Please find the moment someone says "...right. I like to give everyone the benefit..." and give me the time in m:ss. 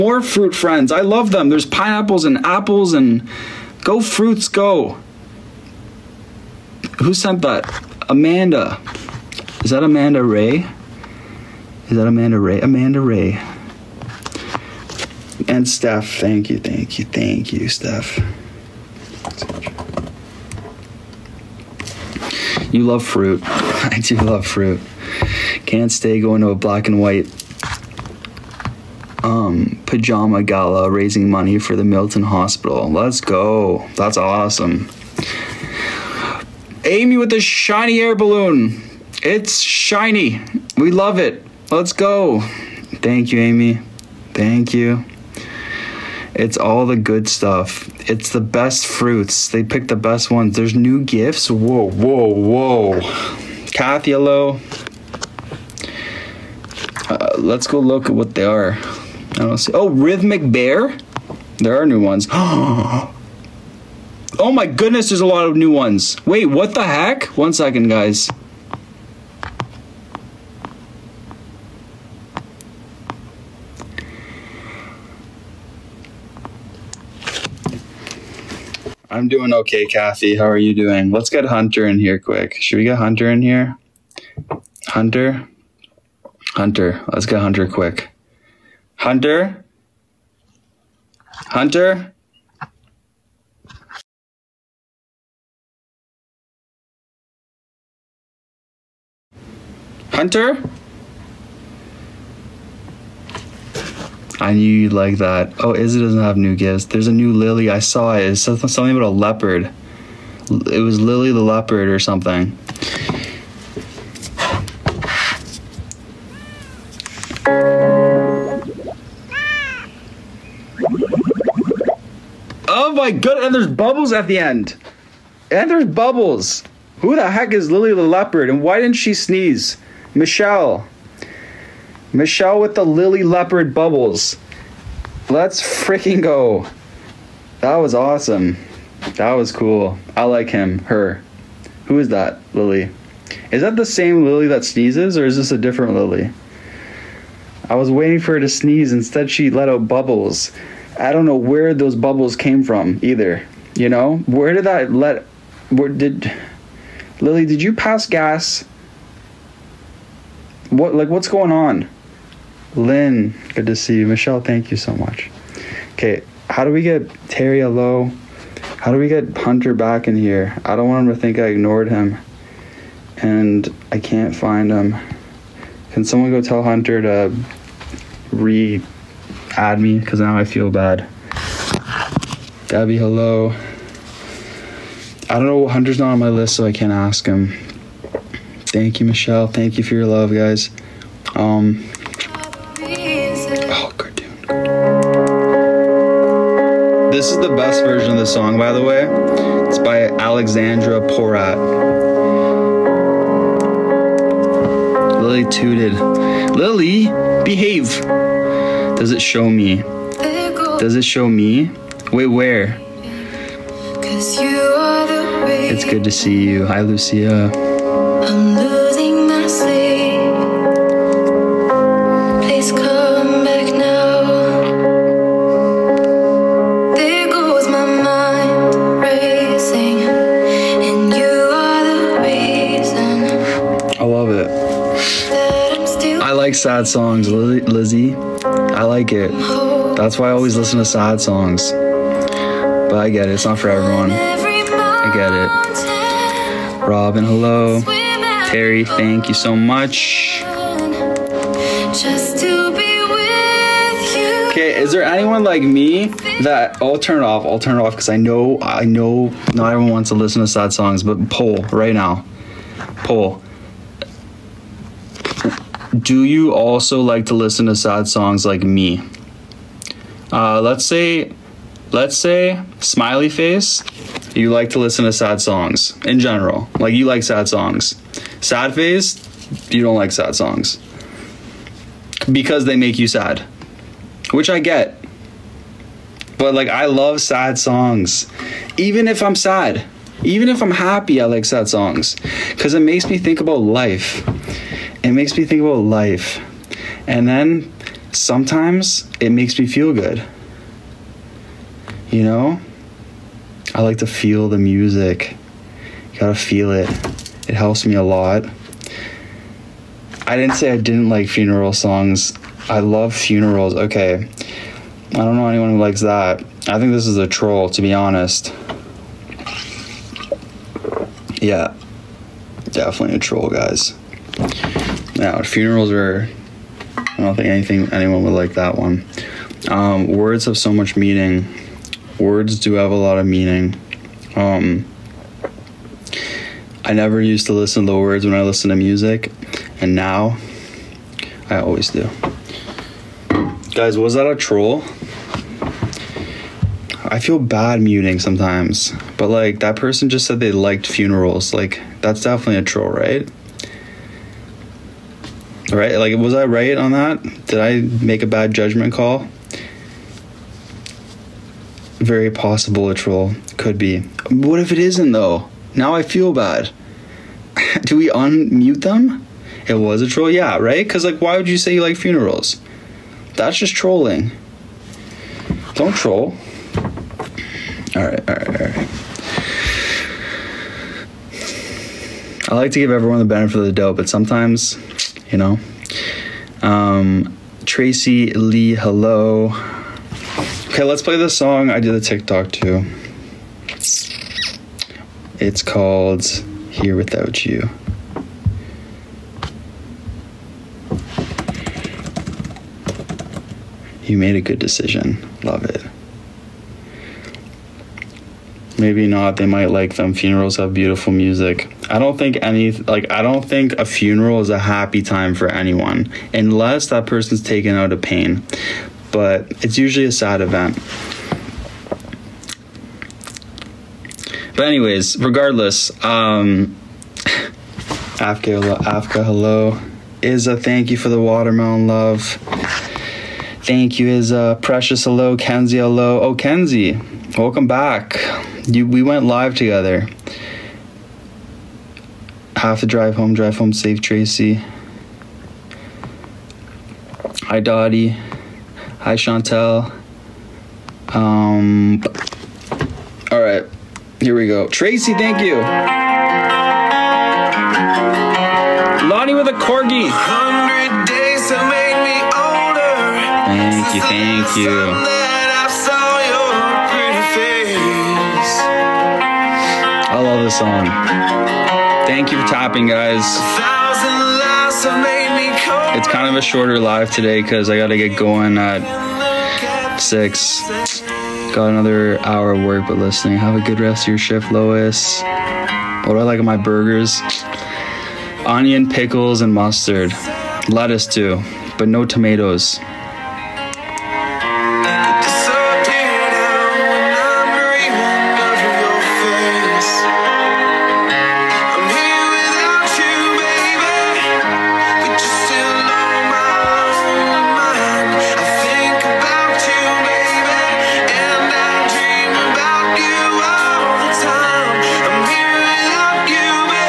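6:18.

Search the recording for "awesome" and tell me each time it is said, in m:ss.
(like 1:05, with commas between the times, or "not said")
0:34, 2:17.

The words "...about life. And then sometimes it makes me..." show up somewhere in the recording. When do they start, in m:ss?
4:55.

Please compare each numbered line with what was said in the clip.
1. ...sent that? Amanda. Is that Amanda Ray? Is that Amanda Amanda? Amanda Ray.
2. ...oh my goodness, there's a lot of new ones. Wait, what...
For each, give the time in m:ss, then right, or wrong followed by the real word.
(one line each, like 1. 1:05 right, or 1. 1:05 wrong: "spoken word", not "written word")
1. 0:07 wrong: "Ray", not "Amanda"
2. 1:02 right.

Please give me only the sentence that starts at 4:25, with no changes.
Do you also like to listen to sad songs like me?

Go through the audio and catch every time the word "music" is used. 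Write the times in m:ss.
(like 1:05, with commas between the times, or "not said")
5:04, 5:38, 6:51.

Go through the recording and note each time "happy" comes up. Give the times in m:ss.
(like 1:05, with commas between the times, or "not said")
4:50, 6:54.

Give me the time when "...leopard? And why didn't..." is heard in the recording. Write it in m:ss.
2:08.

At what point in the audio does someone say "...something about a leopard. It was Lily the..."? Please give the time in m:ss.
1:48.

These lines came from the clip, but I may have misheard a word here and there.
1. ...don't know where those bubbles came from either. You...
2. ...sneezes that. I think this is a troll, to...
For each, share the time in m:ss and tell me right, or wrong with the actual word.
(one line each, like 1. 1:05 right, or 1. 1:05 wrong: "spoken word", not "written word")
1. 2:31 right
2. 5:15 wrong: "likes", not "sneezes".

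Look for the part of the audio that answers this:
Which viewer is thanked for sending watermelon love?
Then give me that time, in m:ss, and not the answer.
7:10.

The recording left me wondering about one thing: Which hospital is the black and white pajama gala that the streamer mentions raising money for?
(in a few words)
Milton Hospital.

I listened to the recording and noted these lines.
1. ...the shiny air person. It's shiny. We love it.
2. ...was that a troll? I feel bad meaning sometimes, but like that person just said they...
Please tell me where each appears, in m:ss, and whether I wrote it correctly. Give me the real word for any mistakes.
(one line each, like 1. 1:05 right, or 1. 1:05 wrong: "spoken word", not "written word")
1. 0:37 wrong: "balloon", not "person"
2. 5:43 wrong: "muting", not "meaning".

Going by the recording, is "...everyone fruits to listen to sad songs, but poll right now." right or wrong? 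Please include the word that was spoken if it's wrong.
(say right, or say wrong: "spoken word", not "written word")
wrong: "wants", not "fruits".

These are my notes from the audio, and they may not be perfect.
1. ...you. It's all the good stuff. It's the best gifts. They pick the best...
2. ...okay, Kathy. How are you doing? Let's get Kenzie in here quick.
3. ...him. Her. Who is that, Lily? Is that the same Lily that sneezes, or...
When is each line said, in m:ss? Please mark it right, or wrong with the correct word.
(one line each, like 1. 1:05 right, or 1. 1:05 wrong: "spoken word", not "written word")
1. 0:44 wrong: "fruits", not "gifts"
2. 1:19 wrong: "Hunter", not "Kenzie"
3. 2:20 right.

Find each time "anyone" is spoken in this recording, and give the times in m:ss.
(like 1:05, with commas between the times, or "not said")
4:15, 5:15, 5:27, 6:55.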